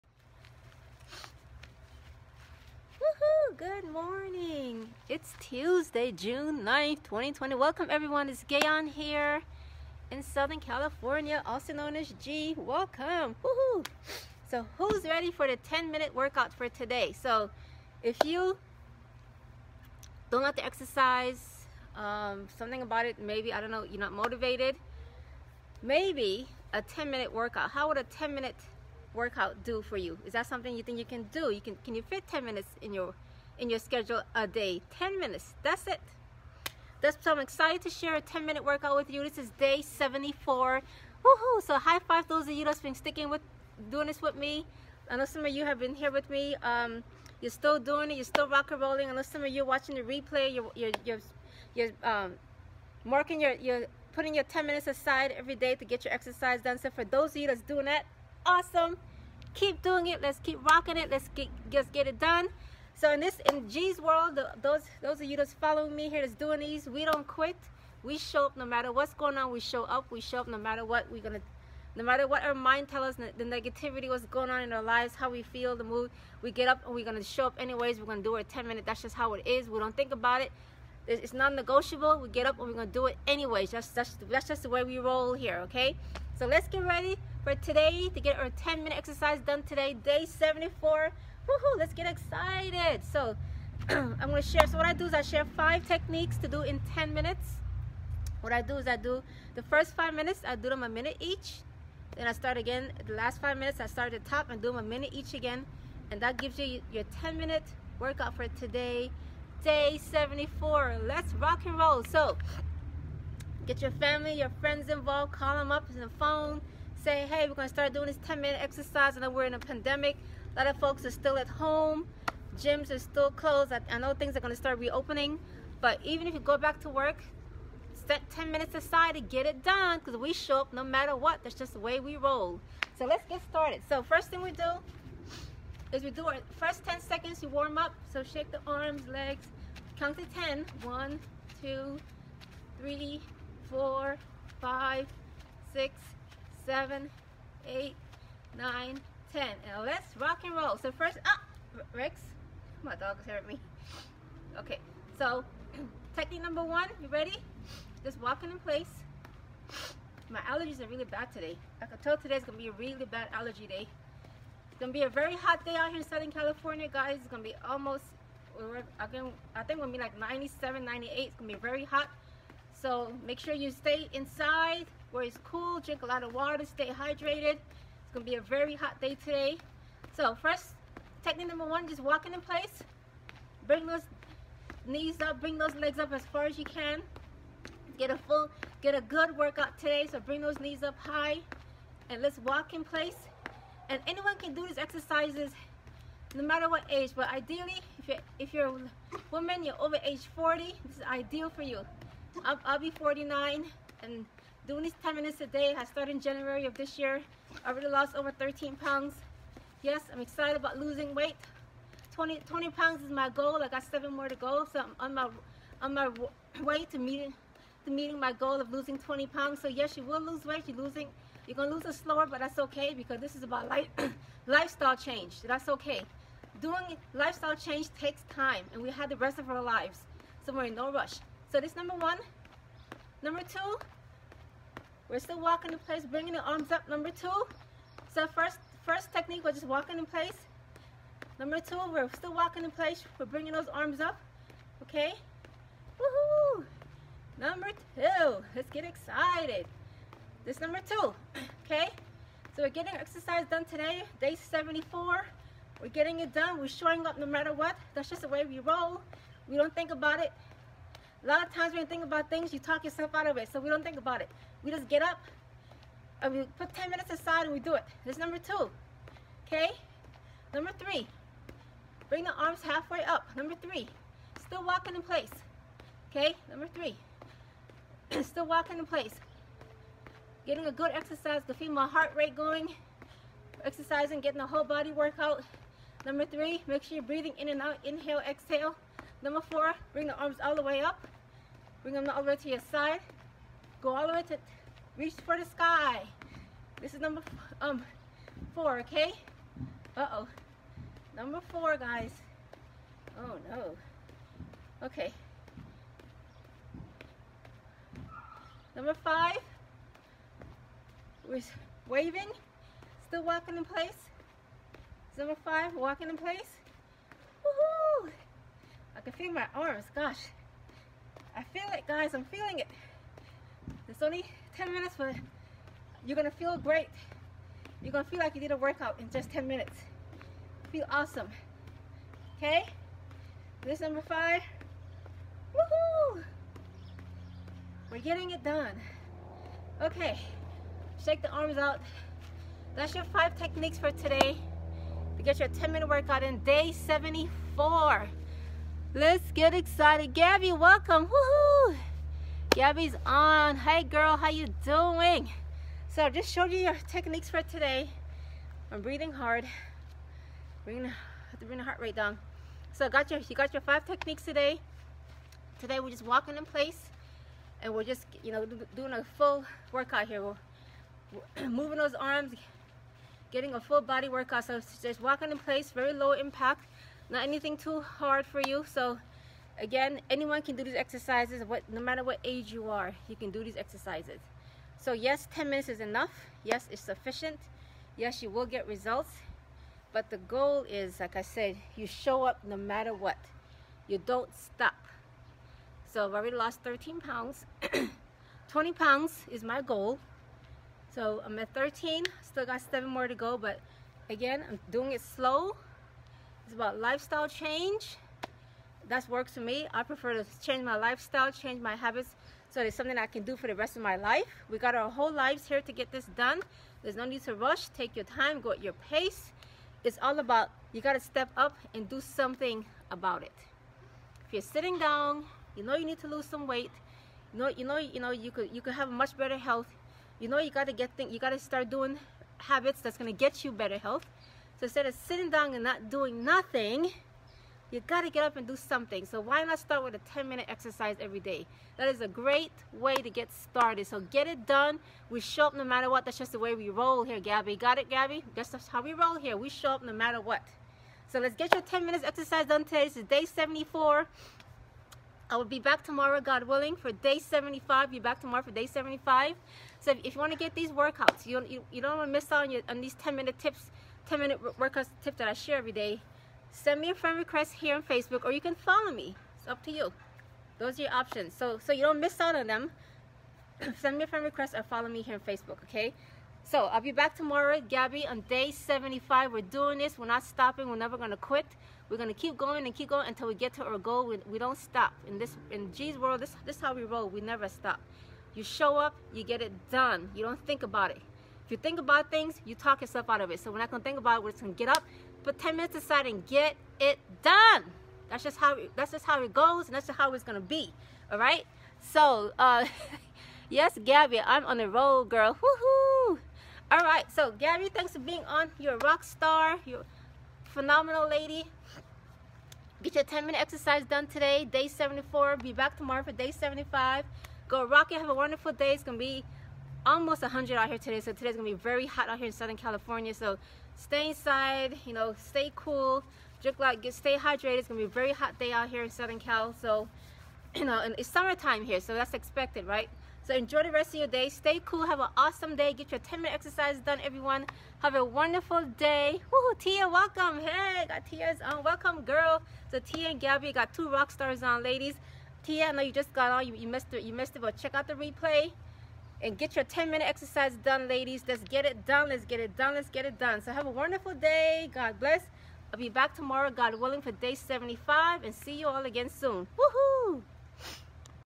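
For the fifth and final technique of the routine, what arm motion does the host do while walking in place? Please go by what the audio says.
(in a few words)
Waving.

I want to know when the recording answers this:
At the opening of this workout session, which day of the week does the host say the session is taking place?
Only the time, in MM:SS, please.
00:05.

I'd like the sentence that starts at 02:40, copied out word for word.
My allergies are really bad today.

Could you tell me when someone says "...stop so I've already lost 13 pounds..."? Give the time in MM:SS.
06:34.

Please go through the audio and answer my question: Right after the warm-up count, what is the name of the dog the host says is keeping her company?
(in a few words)
Rex.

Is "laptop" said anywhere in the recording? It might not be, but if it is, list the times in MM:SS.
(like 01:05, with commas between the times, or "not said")
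not said.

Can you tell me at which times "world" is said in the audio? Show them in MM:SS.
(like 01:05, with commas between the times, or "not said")
01:03, 08:05.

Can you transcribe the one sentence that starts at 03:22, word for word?
I'll, I'll be 49 and Doing these 10 minutes a day, I started in January of this year.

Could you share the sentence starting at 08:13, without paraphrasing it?
So we're not gonna think about it, we're just gonna get up, put 10 minutes aside and get it done.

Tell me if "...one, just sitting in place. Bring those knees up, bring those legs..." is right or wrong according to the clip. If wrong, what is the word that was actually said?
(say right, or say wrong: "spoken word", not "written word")
wrong: "walking", not "sitting".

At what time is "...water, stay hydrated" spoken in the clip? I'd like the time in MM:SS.
02:56.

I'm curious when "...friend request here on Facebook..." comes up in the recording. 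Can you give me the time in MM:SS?
07:46.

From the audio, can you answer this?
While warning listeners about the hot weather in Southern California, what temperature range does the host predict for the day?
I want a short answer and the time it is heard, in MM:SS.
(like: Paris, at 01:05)
97 to 98, at 02:50.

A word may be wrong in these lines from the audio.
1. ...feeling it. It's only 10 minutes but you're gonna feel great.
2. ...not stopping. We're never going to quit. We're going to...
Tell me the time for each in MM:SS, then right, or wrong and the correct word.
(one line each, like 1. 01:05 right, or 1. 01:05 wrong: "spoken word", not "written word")
1. 05:22 right
2. 08:00 right.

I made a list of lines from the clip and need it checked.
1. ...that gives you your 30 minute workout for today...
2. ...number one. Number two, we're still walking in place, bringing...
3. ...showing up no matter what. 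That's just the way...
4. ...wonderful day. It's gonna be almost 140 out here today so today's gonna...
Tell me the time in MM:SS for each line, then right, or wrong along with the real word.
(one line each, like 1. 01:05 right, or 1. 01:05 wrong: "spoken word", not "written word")
1. 01:46 wrong: "10", not "30"
2. 03:51 right
3. 04:16 right
4. 08:38 wrong: "100", not "140".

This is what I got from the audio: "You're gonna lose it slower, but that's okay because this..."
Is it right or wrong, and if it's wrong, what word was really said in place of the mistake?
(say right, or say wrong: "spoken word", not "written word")
right.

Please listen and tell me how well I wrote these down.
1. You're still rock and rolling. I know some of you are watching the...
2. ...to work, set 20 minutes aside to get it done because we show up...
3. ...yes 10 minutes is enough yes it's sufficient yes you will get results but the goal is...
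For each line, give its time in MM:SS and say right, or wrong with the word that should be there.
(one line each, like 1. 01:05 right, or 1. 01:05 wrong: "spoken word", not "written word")
1. 00:48 right
2. 02:06 wrong: "10", not "20"
3. 06:24 right.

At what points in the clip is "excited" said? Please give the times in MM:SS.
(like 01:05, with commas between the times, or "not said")
00:37, 01:32, 03:30, 04:08, 05:49.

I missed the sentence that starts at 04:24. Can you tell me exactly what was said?
We just get up and we put 10 minutes aside and we do it.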